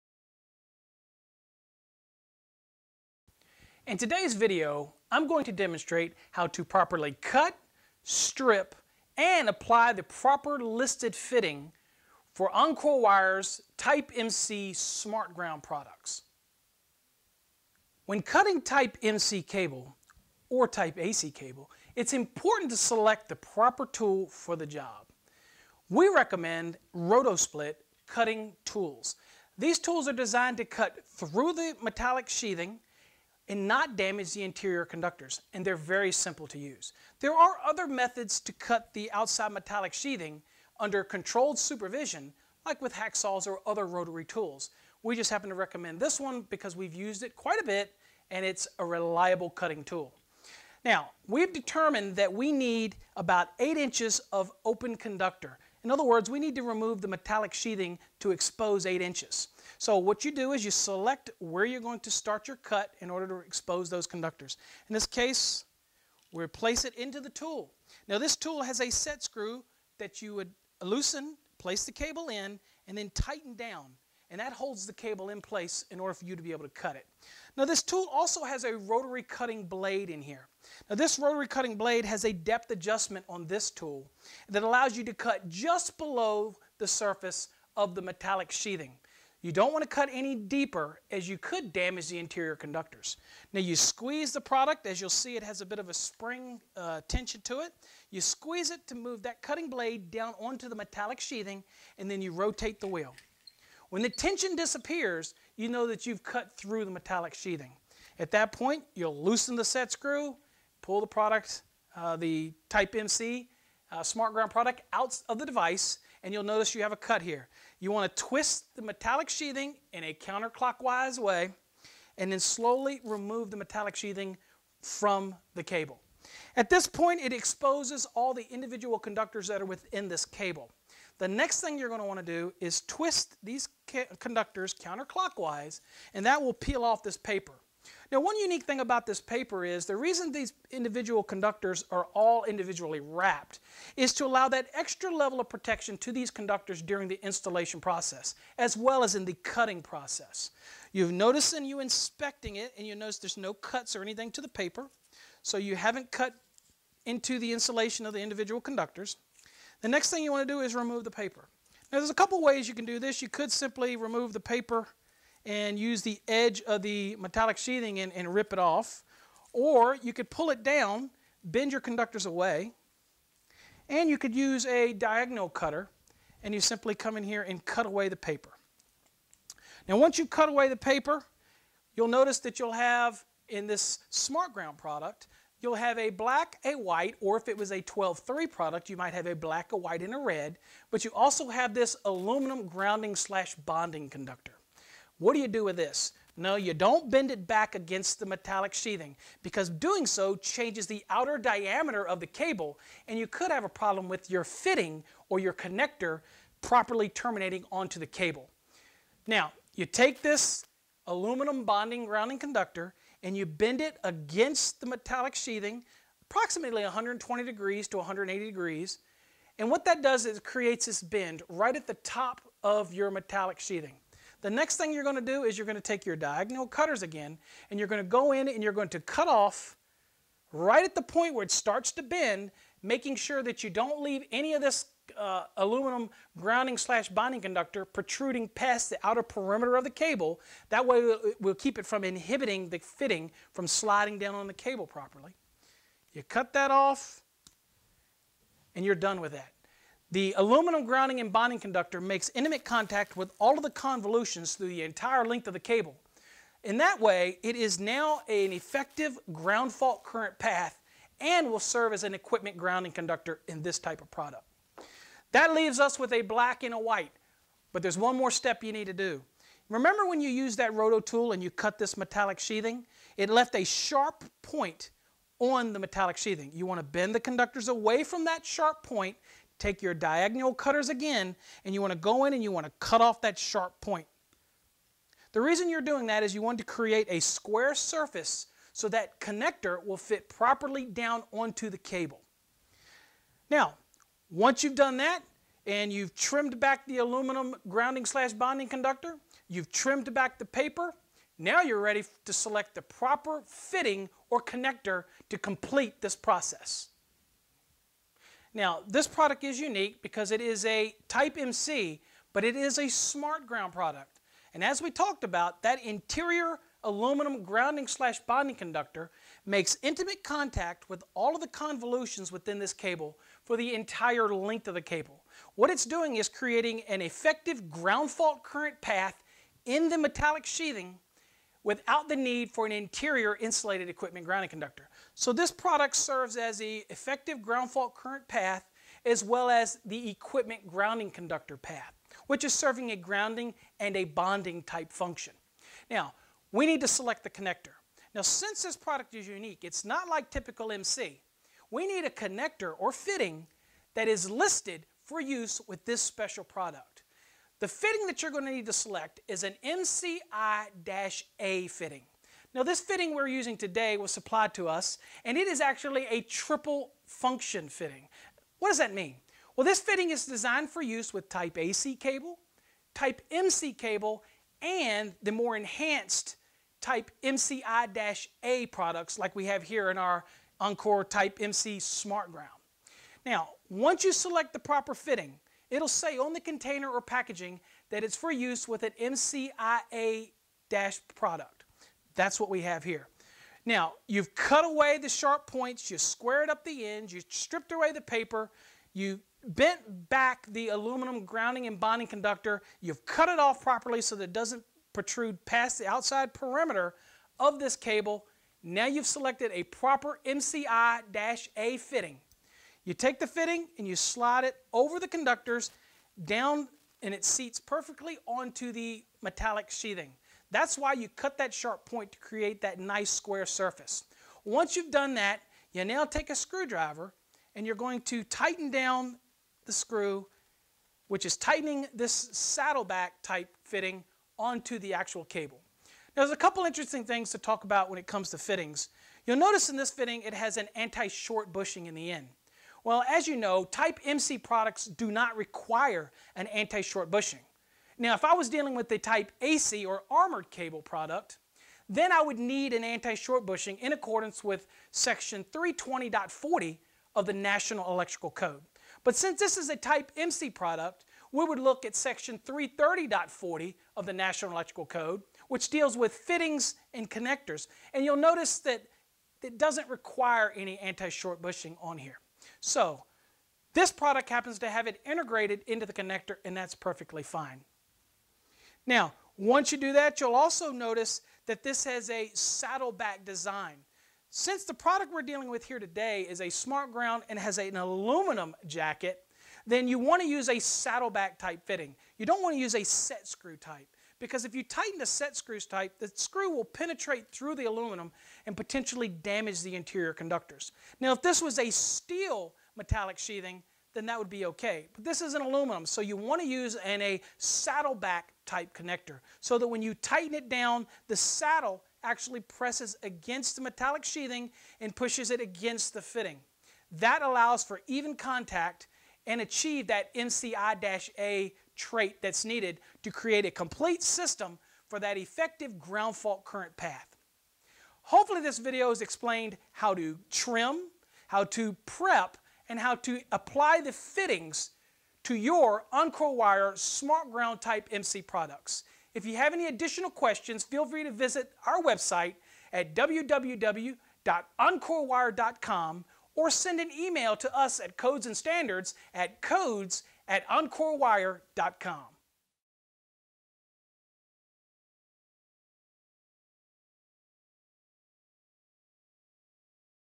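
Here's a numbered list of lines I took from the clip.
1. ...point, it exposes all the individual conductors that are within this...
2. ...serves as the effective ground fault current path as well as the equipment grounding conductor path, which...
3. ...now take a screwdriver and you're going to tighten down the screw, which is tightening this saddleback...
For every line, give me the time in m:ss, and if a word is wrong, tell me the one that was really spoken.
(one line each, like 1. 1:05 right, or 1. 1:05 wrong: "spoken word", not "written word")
1. 2:06 right
2. 5:35 right
3. 7:05 right.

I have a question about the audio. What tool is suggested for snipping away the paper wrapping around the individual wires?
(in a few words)
Diagonal cutter.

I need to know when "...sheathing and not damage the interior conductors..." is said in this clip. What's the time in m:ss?
0:32.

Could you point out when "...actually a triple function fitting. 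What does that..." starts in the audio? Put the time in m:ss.
6:05.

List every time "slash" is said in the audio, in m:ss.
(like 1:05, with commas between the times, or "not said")
3:13, 3:56, 4:58, 5:17.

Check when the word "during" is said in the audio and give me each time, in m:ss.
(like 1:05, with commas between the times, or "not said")
2:26.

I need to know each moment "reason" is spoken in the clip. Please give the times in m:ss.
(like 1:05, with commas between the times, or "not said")
2:19, 4:45.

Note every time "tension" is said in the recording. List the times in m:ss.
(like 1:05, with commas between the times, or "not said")
1:37, 1:44.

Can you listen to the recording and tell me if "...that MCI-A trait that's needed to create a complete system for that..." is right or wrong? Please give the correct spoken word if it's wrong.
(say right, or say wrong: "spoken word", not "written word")
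right.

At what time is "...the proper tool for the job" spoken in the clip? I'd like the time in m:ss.
0:23.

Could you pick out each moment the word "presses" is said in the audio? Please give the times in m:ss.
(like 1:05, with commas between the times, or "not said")
8:32.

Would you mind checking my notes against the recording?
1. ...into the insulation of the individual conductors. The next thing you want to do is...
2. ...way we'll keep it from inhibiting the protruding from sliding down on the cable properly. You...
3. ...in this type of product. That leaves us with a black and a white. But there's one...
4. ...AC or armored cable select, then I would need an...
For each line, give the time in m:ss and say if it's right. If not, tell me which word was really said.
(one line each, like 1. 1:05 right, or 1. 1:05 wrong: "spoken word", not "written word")
1. 2:37 right
2. 4:00 wrong: "fitting", not "protruding"
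3. 4:23 right
4. 7:29 wrong: "product", not "select".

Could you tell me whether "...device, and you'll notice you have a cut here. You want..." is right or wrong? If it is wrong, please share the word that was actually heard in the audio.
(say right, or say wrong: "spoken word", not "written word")
right.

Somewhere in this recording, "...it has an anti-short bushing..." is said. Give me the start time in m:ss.
7:20.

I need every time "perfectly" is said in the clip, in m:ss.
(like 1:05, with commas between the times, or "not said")
6:57, 7:56.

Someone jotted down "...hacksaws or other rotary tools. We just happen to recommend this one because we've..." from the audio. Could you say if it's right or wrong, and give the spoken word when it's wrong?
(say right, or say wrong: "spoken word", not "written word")
right.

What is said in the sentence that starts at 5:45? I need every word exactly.
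Now, we need to select the connector.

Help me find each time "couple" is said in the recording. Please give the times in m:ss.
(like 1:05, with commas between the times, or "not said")
2:42, 7:16.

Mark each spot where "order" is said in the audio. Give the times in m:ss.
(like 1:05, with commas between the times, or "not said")
1:03, 1:15.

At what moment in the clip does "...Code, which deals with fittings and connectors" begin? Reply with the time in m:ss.
7:44.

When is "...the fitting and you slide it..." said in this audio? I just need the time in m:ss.
6:53.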